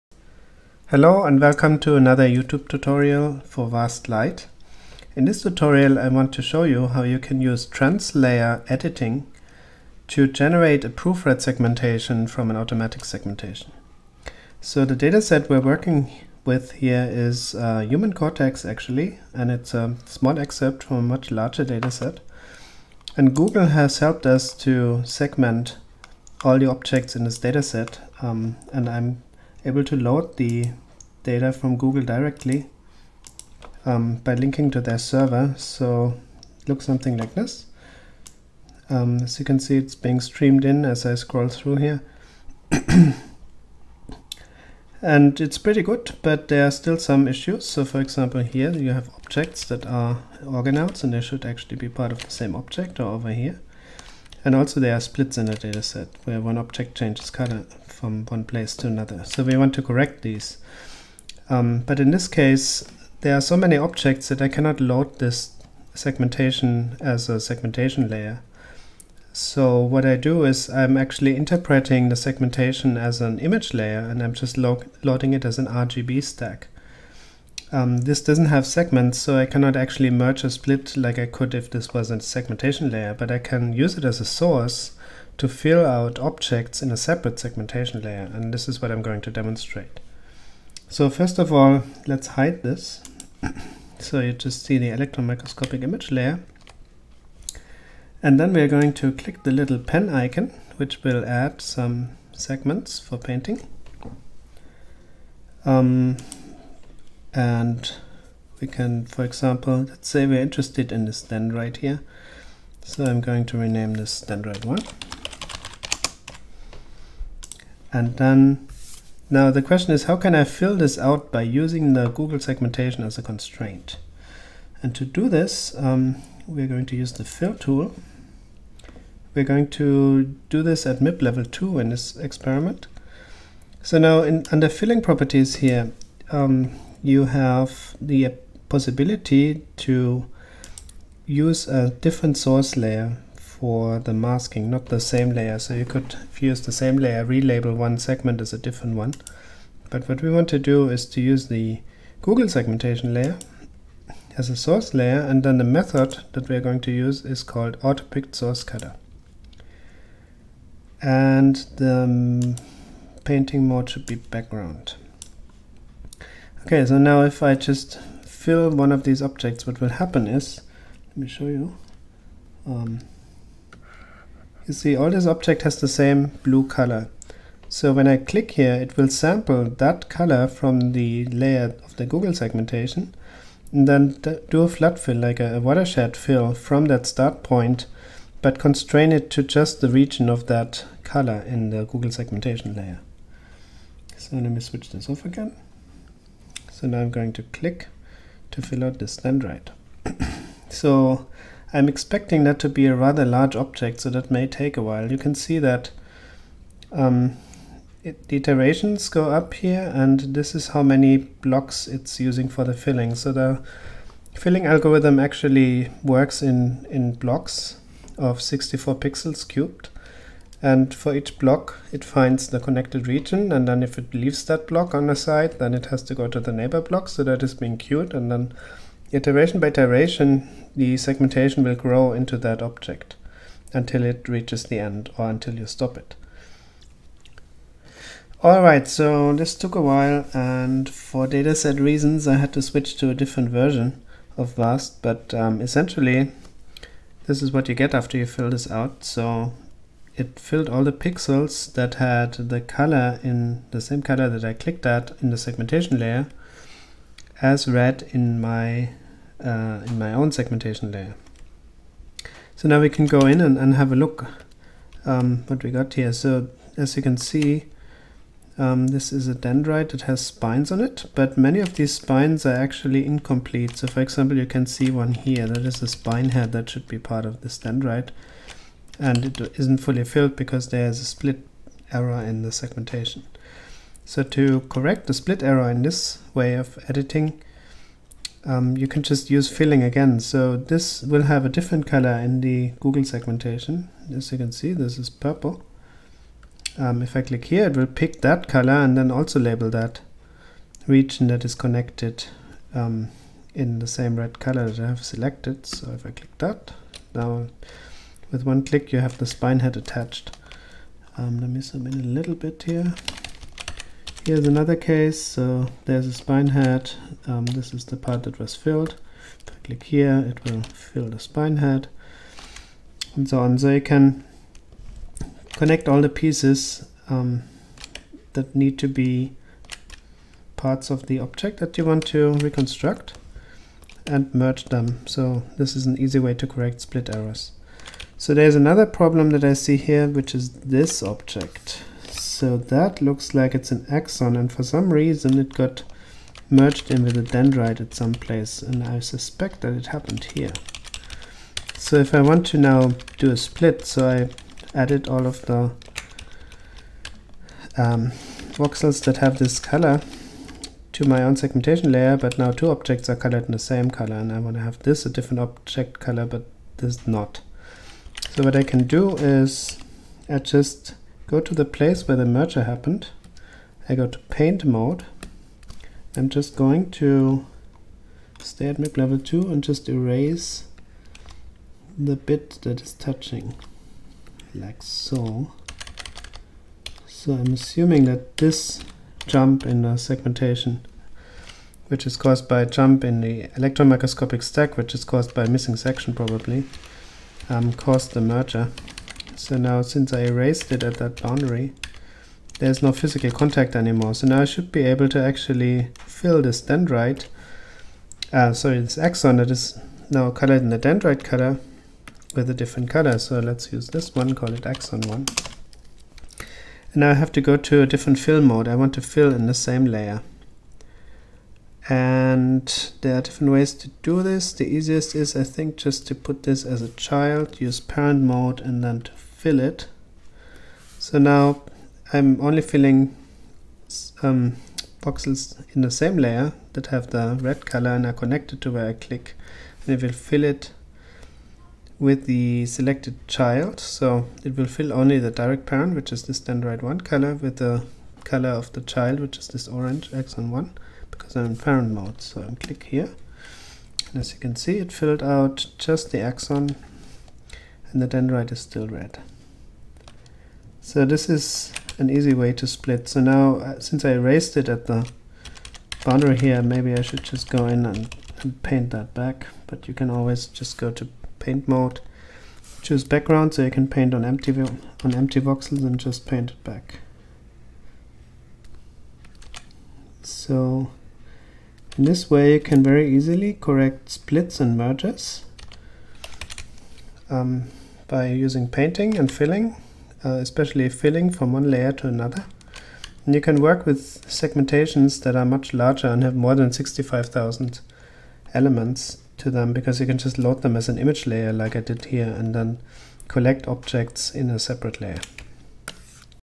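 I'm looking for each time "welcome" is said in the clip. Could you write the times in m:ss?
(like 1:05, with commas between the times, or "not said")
0:01.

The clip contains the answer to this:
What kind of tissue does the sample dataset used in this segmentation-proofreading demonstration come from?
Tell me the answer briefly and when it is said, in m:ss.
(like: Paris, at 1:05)
human cortex, at 0:17.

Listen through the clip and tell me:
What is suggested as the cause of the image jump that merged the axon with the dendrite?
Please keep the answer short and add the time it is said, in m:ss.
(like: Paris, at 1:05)
a missing section, at 6:35.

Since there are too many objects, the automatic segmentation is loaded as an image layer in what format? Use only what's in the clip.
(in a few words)
RGB stack.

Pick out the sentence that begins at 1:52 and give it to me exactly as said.
So I'm going to rename this dendrite 1.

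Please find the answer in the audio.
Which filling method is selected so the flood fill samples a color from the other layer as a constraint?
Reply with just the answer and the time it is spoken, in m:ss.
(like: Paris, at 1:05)
autopicked source cutter, at 2:37.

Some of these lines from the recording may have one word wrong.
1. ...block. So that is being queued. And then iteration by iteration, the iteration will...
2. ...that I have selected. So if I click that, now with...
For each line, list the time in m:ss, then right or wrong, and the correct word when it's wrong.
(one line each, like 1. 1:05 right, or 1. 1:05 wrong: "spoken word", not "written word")
1. 3:46 wrong: "segmentation", not "iteration"
2. 5:04 right.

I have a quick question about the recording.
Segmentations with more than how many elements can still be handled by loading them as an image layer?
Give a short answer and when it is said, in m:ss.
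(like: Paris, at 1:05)
65,000, at 8:16.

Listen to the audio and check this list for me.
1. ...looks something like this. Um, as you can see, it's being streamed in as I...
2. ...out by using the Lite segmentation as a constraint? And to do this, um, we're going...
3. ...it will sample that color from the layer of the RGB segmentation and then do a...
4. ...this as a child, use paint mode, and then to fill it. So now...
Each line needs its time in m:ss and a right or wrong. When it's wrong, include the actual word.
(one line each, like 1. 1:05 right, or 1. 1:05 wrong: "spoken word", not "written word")
1. 0:36 right
2. 2:00 wrong: "Google", not "Lite"
3. 2:58 wrong: "Google", not "RGB"
4. 7:06 wrong: "parent", not "paint".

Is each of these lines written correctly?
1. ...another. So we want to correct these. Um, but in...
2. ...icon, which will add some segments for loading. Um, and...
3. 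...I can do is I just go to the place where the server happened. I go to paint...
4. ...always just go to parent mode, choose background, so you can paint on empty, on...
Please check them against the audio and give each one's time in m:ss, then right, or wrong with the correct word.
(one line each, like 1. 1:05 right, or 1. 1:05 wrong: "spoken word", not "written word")
1. 0:58 right
2. 1:40 wrong: "painting", not "loading"
3. 6:08 wrong: "merger", not "server"
4. 7:50 wrong: "paint", not "parent".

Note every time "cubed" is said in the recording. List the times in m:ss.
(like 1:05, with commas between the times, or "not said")
3:39.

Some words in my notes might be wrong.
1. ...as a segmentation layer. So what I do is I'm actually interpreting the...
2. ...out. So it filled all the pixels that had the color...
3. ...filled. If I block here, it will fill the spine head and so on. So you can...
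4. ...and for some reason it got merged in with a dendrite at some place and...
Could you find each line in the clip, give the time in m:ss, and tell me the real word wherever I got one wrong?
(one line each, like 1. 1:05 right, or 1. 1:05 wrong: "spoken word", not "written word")
1. 1:07 right
2. 4:08 right
3. 5:18 wrong: "click", not "block"
4. 5:44 right.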